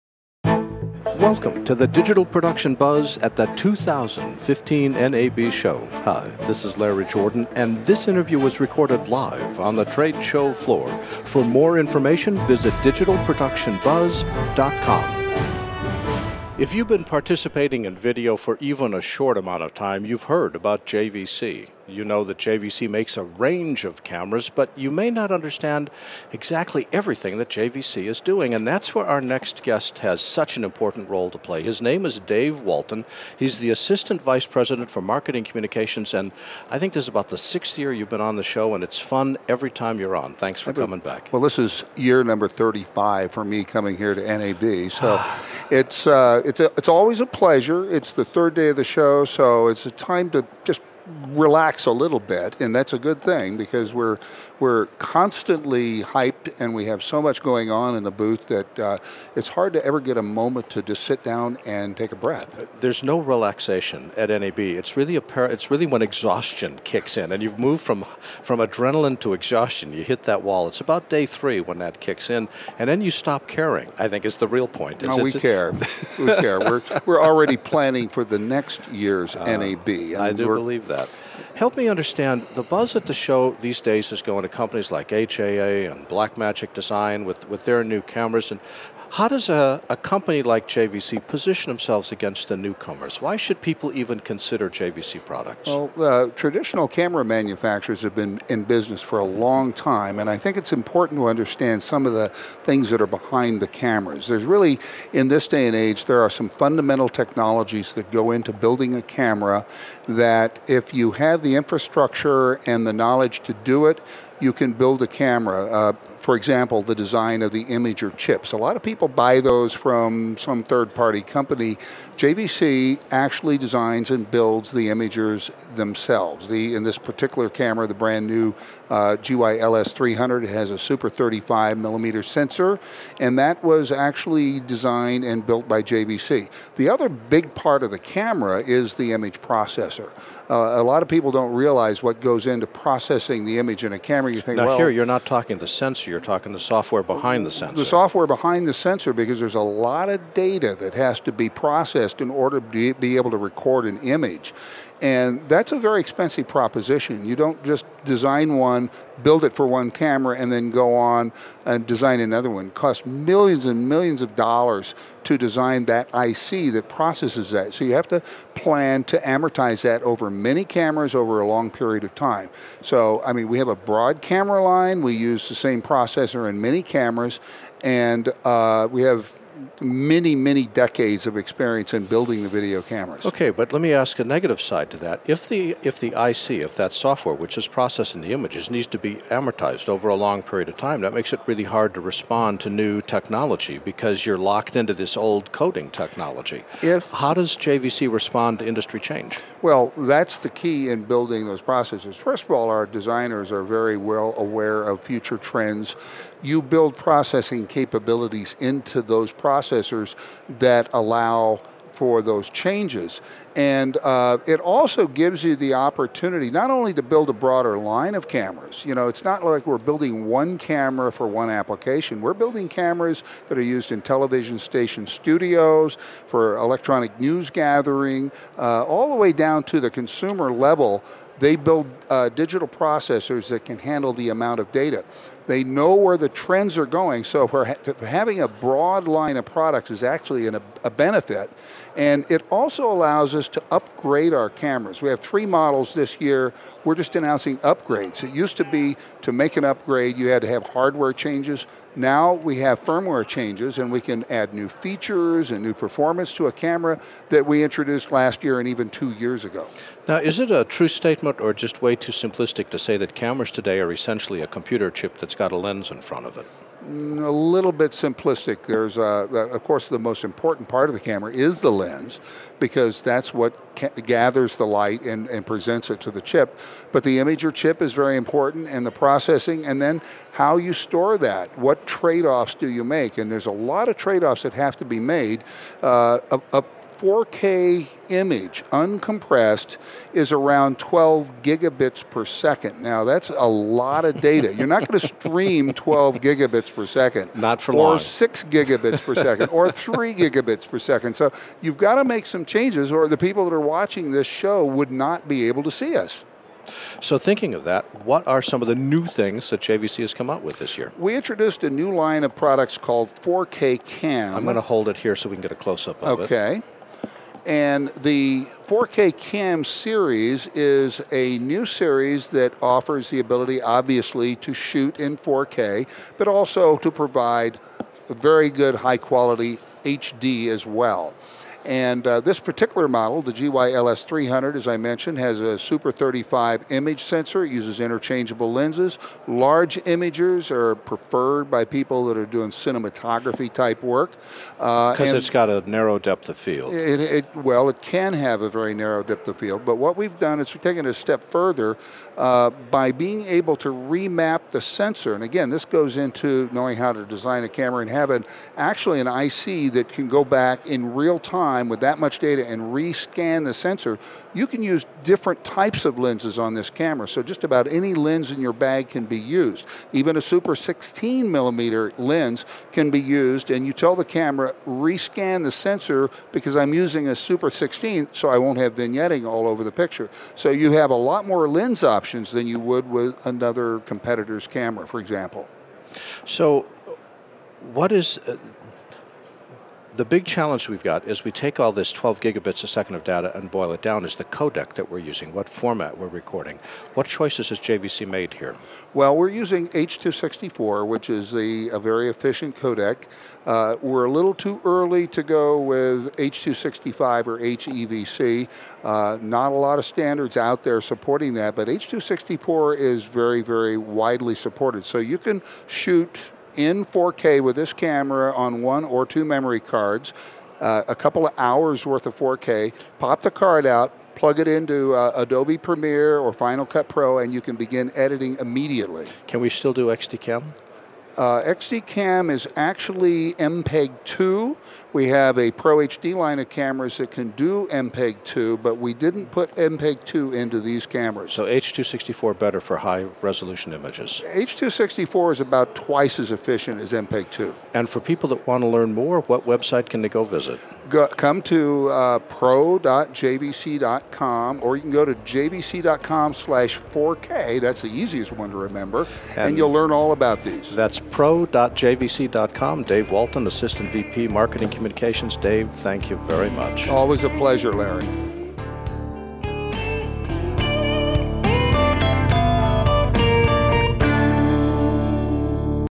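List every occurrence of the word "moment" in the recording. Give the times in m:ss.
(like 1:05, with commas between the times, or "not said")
1:00.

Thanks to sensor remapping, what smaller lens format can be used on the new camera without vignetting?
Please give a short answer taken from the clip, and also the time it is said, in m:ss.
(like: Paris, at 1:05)
Super 16 millimeter, at 6:10.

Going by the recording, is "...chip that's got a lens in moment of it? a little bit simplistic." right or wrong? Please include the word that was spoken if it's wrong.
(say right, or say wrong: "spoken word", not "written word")
wrong: "front", not "moment".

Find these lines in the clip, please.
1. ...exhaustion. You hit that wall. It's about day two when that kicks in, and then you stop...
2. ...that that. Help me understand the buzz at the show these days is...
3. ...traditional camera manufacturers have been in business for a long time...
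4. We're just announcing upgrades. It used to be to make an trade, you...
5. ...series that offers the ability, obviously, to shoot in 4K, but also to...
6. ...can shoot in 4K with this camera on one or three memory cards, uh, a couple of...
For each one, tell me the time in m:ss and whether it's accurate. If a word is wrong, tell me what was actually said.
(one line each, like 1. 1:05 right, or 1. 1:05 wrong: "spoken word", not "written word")
1. 1:09 wrong: "three", not "two"
2. 1:20 right
3. 1:36 right
4. 4:06 wrong: "upgrade", not "trade"
5. 5:21 right
6. 6:55 wrong: "two", not "three".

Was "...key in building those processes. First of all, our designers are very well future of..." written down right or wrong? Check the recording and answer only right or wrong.
wrong.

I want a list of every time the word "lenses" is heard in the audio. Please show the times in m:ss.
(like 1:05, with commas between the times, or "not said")
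5:38, 6:05.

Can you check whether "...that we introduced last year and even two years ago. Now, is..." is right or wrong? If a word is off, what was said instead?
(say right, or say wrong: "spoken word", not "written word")
right.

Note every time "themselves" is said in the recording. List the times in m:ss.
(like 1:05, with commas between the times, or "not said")
1:31, 2:05.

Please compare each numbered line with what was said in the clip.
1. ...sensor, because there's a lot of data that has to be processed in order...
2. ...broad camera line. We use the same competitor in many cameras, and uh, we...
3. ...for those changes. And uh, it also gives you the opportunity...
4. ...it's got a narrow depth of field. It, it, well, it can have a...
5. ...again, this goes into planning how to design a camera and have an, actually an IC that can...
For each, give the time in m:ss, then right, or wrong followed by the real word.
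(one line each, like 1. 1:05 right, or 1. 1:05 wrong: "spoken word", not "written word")
1. 2:28 right
2. 2:53 wrong: "processor", not "competitor"
3. 3:31 right
4. 5:45 right
5. 5:55 wrong: "knowing", not "planning".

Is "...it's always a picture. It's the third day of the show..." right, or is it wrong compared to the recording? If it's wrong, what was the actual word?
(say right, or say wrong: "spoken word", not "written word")
wrong: "pleasure", not "picture".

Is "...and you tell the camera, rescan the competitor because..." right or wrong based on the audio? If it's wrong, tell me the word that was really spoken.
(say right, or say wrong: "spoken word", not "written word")
wrong: "sensor", not "competitor".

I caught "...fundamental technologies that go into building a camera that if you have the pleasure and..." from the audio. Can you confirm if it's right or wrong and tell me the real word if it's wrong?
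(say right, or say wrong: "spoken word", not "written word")
wrong: "infrastructure", not "pleasure".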